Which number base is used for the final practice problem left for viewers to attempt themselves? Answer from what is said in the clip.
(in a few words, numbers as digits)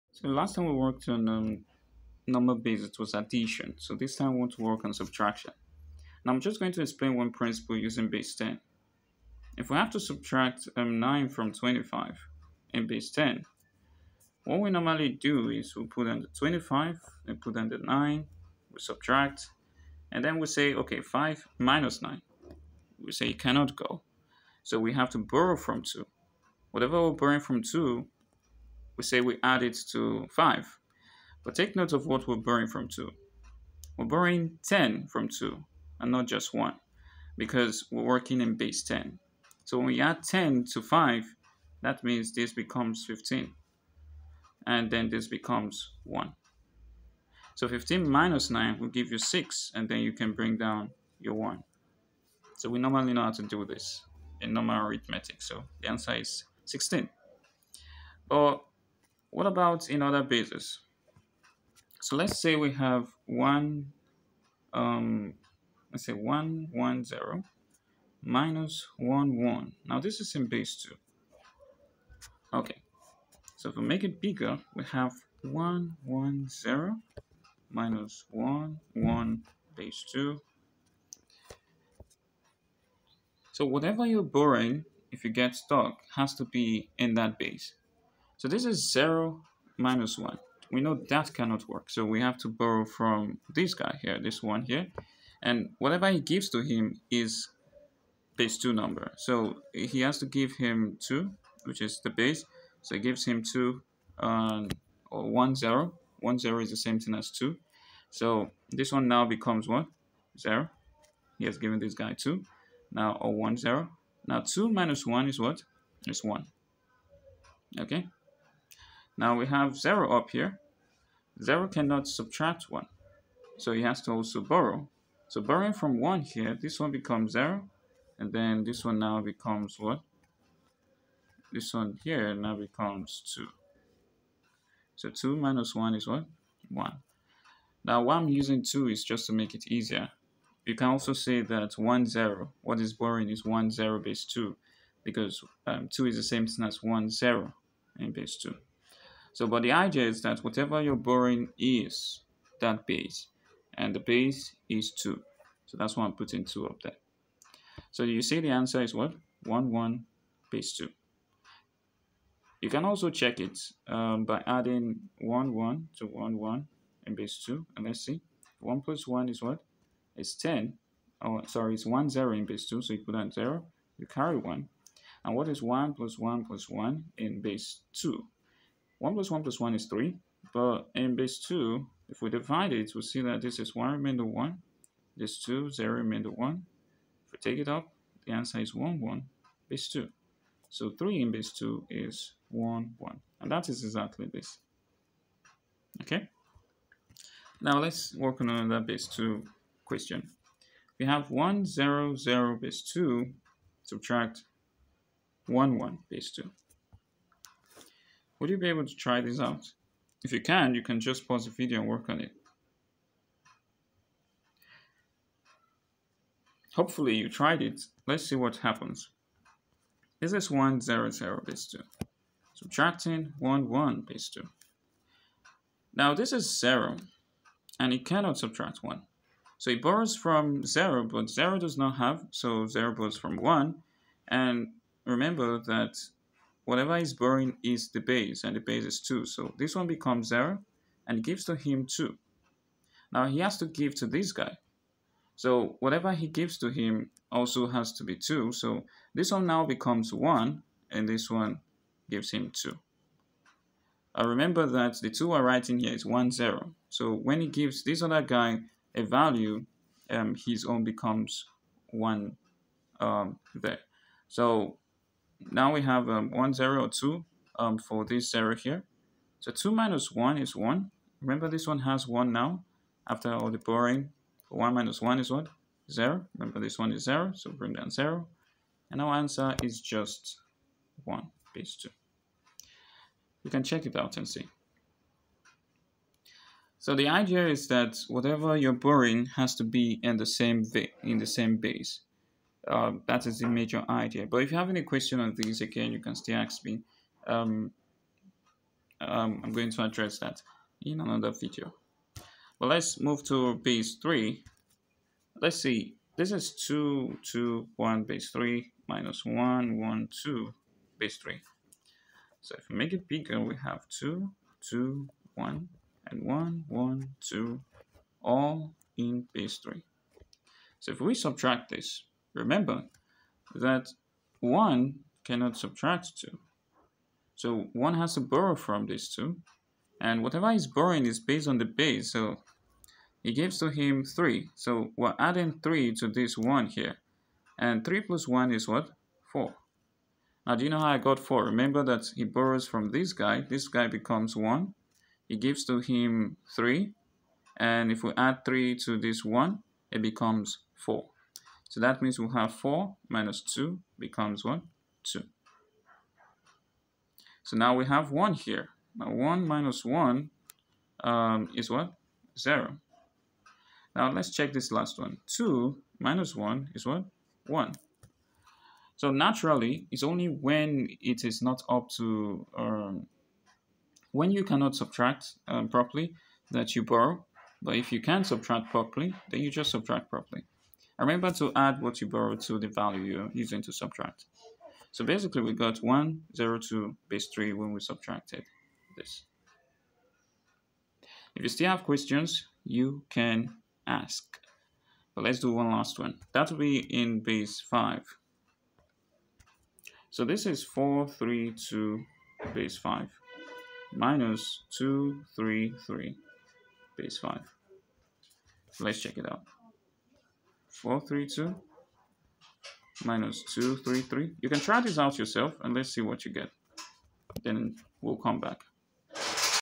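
base 5.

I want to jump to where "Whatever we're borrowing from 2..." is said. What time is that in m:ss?
0:26.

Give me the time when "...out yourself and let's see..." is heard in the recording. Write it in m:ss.
6:54.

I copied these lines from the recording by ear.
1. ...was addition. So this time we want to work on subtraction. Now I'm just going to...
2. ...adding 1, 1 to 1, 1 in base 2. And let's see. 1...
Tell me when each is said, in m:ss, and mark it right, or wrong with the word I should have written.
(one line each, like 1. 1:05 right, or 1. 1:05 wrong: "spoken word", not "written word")
1. 0:02 right
2. 2:44 right.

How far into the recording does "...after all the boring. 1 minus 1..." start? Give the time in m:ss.
4:33.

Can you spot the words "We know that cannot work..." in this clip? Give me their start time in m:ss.
1:30.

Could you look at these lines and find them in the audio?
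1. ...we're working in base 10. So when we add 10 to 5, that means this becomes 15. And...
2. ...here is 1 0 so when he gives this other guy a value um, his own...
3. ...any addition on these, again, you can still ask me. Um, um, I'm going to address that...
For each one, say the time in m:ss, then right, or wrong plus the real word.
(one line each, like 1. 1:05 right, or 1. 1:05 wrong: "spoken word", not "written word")
1. 0:37 right
2. 4:15 right
3. 4:54 wrong: "question", not "addition".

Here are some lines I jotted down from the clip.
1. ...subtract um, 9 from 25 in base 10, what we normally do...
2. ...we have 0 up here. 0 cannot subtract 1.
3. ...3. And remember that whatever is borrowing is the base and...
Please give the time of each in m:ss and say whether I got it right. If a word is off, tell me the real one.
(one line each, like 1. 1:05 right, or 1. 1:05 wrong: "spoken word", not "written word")
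1. 0:09 right
2. 1:59 right
3. 3:53 wrong: "1", not "3".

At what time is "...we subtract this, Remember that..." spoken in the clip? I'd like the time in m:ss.
5:21.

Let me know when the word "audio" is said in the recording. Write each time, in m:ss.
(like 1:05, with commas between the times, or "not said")
not said.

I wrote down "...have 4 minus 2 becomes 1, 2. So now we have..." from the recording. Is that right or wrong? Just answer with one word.
right.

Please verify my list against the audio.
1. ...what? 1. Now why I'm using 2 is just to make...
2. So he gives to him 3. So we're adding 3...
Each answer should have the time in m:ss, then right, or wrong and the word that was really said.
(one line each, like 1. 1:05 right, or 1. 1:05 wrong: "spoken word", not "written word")
1. 2:16 right
2. 5:32 right.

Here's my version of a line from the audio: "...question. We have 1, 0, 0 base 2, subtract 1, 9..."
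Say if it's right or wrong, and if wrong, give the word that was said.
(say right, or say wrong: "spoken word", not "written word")
wrong: "1", not "9".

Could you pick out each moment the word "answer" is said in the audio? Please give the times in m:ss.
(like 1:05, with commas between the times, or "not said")
0:55, 2:38, 3:08, 4:39.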